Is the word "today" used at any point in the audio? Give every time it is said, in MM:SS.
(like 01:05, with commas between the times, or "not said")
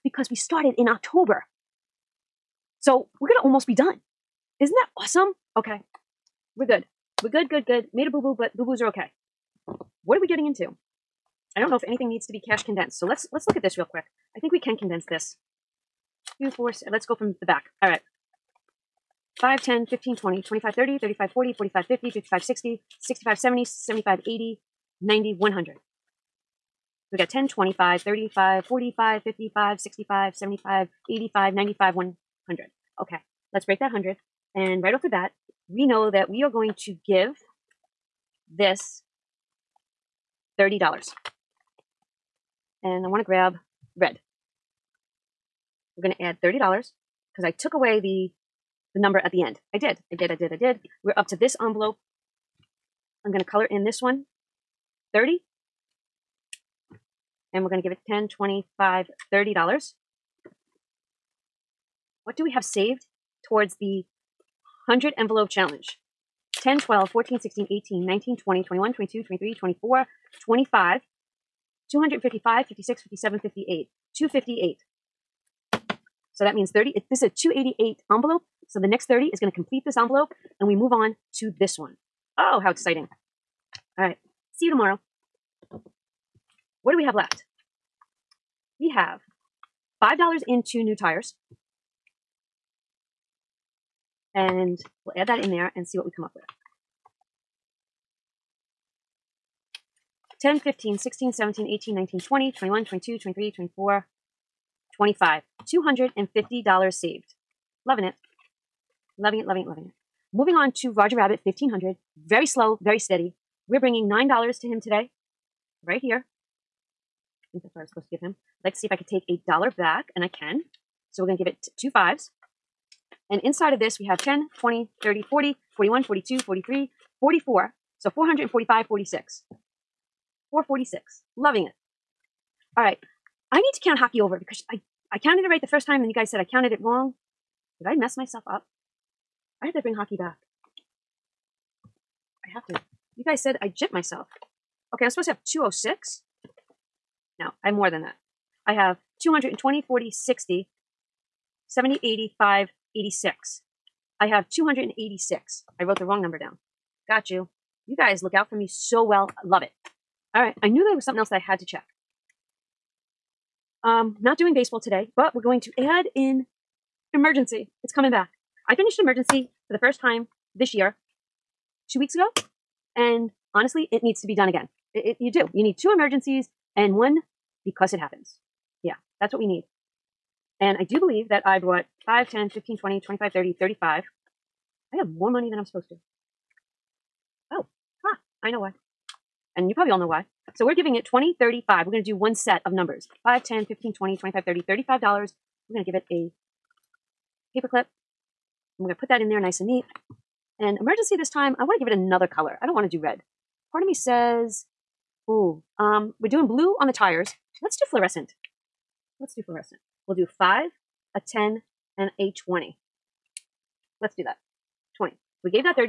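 01:54, 02:44.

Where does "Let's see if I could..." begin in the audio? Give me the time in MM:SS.
01:58.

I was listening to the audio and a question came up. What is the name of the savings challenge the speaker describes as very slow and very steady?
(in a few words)
Roger Rabbit 1500.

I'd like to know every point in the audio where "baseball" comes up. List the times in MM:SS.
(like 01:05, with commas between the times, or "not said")
02:44.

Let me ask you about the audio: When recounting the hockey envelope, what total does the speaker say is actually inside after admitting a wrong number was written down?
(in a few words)
286.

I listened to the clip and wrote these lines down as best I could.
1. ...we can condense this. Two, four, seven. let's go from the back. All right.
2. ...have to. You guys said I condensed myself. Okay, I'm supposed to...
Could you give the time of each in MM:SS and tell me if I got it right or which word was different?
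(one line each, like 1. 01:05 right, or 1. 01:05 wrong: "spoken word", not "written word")
1. 00:14 right
2. 02:22 wrong: "jipped", not "condensed".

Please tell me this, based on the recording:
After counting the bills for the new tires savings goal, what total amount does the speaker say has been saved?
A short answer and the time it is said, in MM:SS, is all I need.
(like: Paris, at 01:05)
$250, at 01:45.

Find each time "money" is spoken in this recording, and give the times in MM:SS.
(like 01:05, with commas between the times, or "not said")
03:05.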